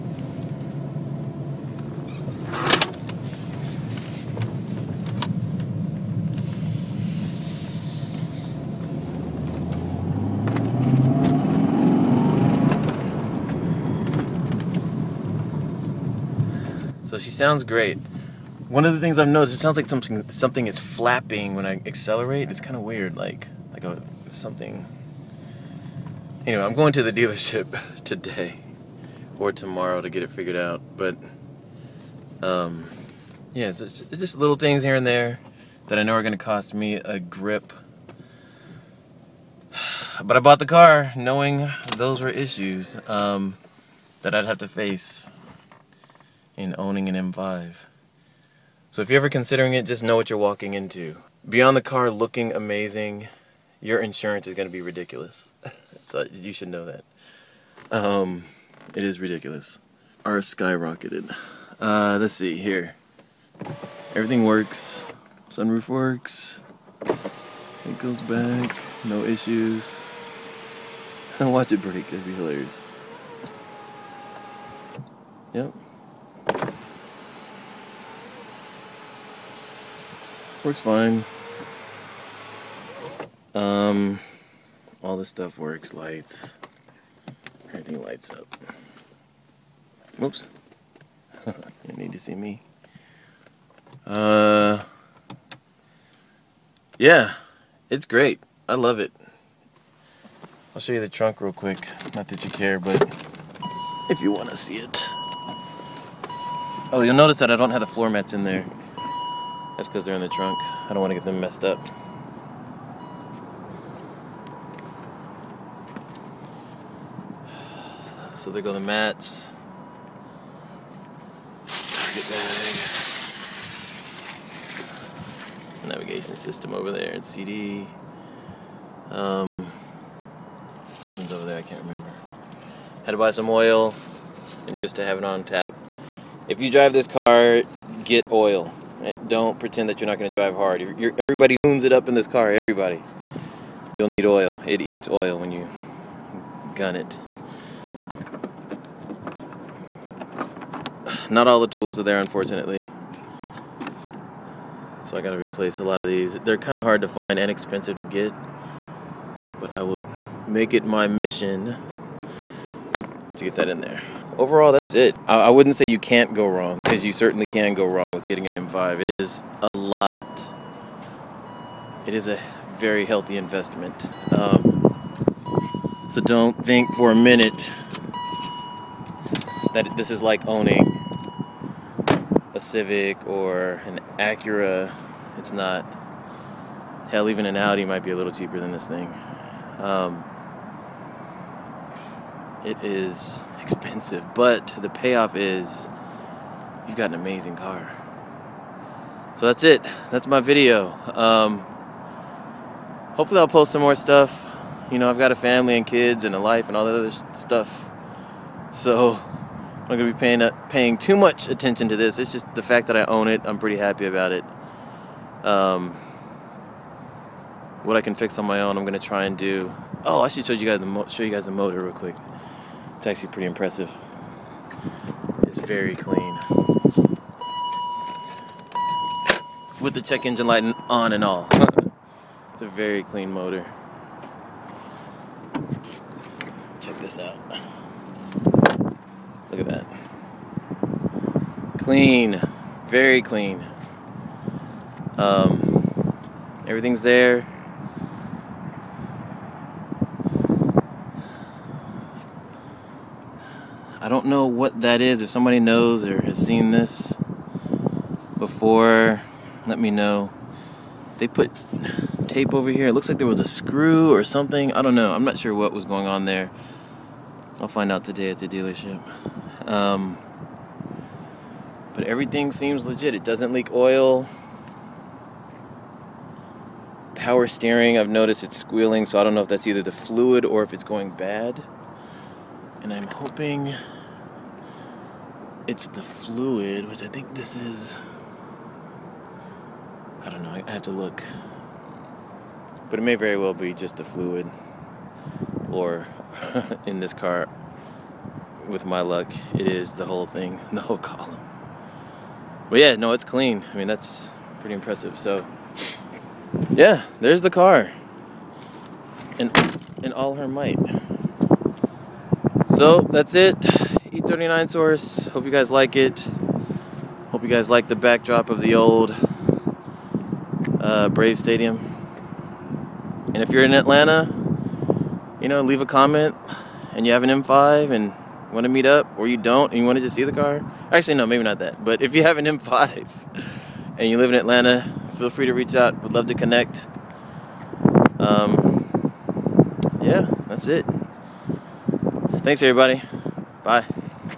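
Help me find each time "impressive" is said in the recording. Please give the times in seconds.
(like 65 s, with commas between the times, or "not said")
223 s, 304 s.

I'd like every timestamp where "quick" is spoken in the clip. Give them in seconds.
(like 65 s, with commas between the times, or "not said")
101 s, 221 s.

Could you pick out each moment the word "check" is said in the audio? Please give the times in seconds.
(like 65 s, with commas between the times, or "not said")
230 s, 236 s.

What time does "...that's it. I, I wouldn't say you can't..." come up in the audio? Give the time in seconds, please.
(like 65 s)
164 s.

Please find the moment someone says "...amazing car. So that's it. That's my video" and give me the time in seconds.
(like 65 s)
197 s.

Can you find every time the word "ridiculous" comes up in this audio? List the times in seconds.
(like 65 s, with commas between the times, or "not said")
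54 s, 59 s.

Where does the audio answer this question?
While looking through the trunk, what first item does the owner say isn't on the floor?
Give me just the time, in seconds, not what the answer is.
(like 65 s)
107 s.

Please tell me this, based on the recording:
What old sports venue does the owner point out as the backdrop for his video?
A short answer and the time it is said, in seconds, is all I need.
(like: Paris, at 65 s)
Brave Stadium, at 321 s.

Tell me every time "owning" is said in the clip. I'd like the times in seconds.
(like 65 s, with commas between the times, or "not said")
46 s, 180 s.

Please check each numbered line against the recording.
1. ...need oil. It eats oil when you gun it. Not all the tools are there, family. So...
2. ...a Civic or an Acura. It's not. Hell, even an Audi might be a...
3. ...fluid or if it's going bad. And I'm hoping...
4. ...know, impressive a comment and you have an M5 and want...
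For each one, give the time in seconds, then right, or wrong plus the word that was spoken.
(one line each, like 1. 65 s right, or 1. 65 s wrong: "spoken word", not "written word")
1. 144 s wrong: "unfortunately", not "family"
2. 182 s right
3. 279 s right
4. 325 s wrong: "leave", not "impressive".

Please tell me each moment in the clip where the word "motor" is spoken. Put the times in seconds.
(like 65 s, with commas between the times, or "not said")
221 s, 233 s.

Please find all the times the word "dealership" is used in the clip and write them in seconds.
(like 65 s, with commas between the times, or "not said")
27 s, 268 s.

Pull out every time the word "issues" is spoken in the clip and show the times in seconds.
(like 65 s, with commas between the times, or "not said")
42 s, 69 s.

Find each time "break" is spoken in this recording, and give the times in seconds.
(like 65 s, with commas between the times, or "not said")
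71 s.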